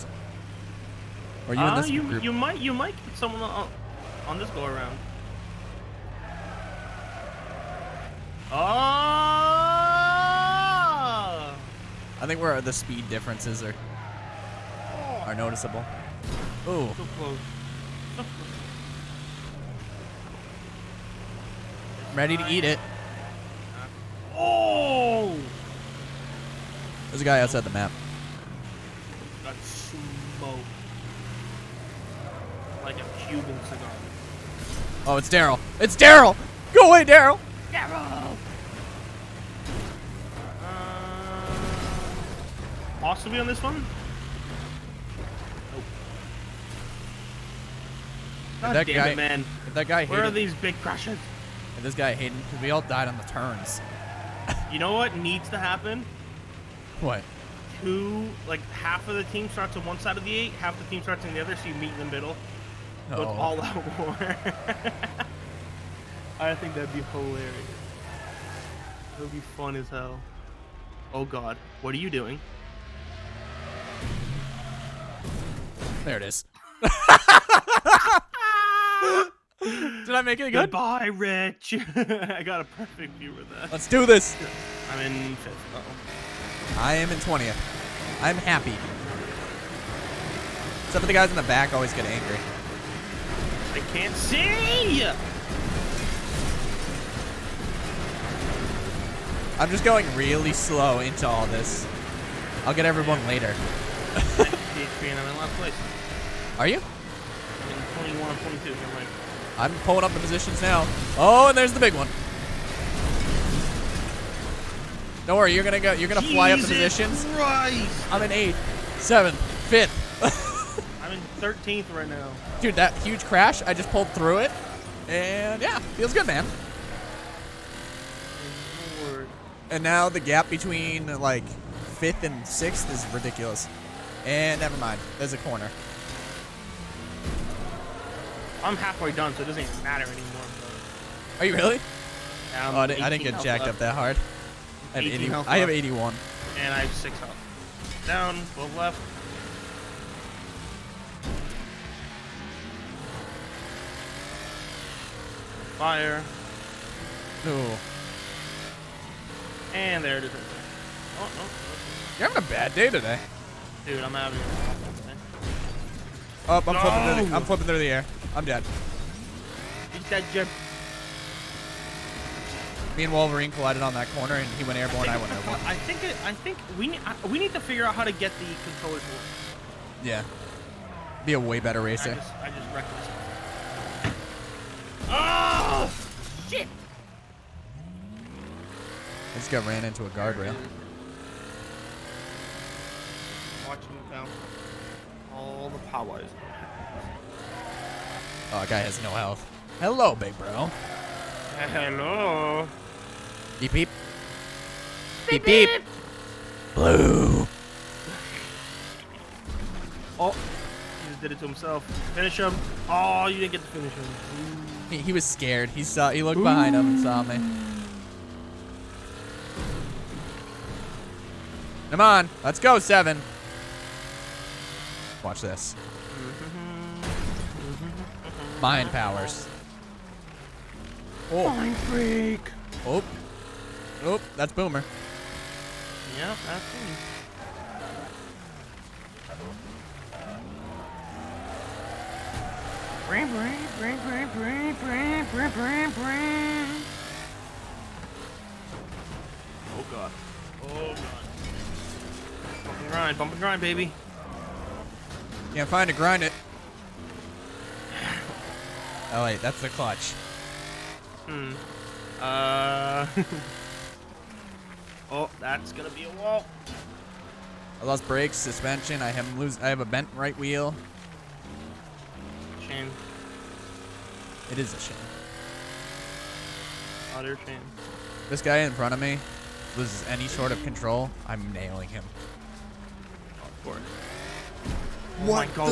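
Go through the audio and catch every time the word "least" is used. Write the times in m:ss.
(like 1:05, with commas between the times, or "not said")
not said.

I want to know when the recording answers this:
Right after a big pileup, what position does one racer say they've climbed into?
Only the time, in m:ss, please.
2:01.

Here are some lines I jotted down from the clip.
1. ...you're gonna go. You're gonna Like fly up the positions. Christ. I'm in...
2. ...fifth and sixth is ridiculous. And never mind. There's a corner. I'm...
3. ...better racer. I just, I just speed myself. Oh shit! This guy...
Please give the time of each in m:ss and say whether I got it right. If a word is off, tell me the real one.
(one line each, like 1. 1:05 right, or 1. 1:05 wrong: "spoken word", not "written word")
1. 1:55 wrong: "Jesus", not "Like"
2. 2:11 right
3. 3:01 wrong: "wrecked", not "speed".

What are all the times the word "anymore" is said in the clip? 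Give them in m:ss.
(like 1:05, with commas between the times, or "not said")
2:20.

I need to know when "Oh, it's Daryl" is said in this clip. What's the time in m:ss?
0:35.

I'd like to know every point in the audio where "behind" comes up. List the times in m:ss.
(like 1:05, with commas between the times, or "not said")
3:36.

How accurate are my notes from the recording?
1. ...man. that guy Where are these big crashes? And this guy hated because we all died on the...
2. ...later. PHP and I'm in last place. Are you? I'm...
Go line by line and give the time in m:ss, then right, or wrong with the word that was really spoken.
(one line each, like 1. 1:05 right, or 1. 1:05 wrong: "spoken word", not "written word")
1. 0:49 right
2. 1:43 right.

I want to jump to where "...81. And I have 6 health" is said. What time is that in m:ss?
2:25.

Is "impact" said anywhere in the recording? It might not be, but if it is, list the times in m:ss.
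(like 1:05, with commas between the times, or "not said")
not said.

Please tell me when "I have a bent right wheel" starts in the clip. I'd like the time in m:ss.
4:29.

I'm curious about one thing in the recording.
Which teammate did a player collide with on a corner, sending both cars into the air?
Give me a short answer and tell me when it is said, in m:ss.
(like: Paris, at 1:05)
Wolverine, at 2:53.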